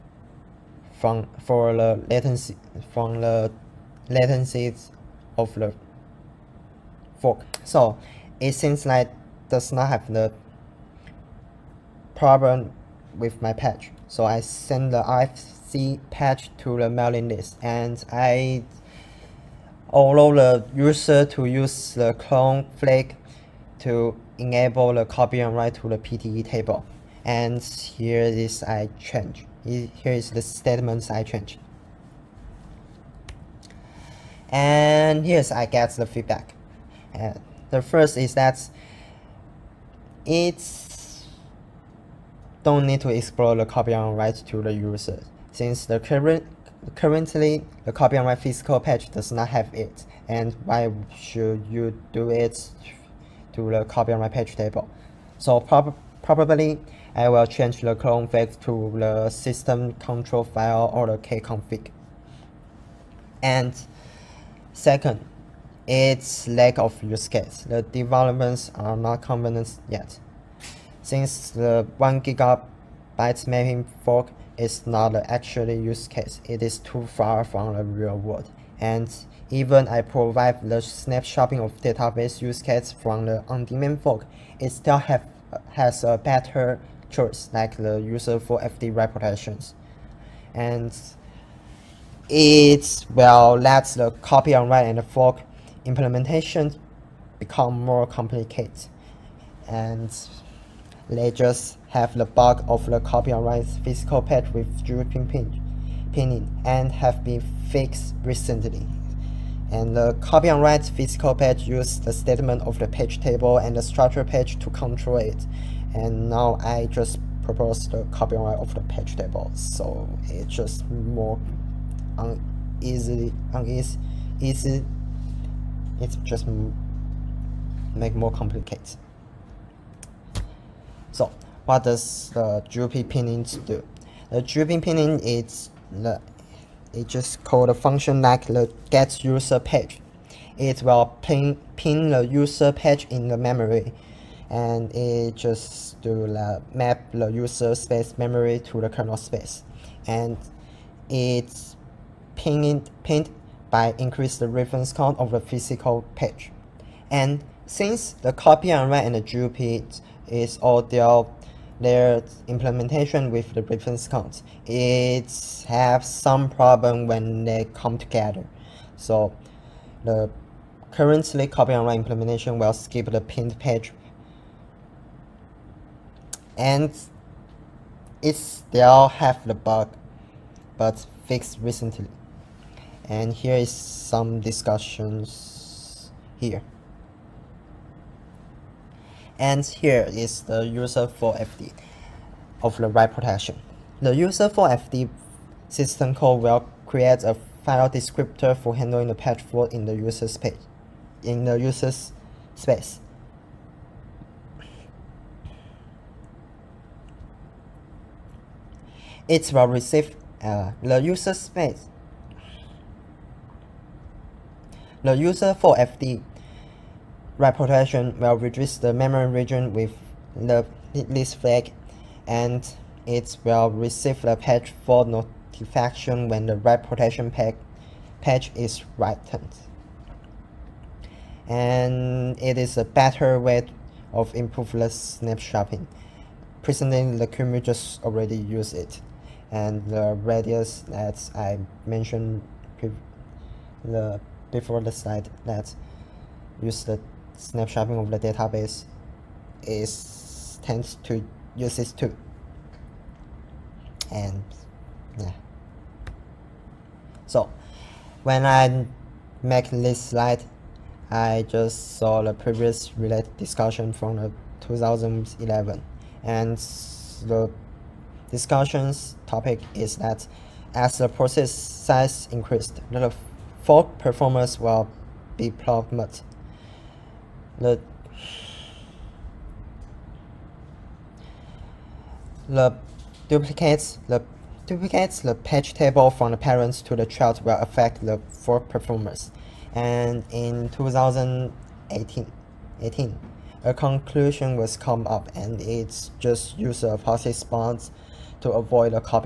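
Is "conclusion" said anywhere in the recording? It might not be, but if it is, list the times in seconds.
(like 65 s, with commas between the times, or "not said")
293 s.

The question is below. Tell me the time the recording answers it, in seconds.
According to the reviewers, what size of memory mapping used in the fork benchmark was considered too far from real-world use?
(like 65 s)
71 s.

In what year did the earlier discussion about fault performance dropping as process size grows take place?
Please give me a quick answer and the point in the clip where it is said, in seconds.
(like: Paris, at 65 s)
2011, at 264 s.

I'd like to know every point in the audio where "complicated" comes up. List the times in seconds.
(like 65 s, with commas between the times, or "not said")
98 s, 128 s.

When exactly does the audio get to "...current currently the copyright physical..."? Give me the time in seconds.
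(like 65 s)
45 s.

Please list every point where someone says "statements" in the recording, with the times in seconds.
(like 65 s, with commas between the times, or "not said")
30 s, 112 s.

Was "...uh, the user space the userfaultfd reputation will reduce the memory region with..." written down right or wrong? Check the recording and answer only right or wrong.
right.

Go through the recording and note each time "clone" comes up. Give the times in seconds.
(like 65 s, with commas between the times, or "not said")
22 s, 57 s.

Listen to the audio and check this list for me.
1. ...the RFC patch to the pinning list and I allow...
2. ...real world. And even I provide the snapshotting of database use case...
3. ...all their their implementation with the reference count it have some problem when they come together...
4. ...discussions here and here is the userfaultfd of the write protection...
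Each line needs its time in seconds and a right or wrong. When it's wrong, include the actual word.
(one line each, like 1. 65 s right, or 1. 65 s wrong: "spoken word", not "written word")
1. 14 s wrong: "mailing", not "pinning"
2. 77 s right
3. 160 s right
4. 184 s right.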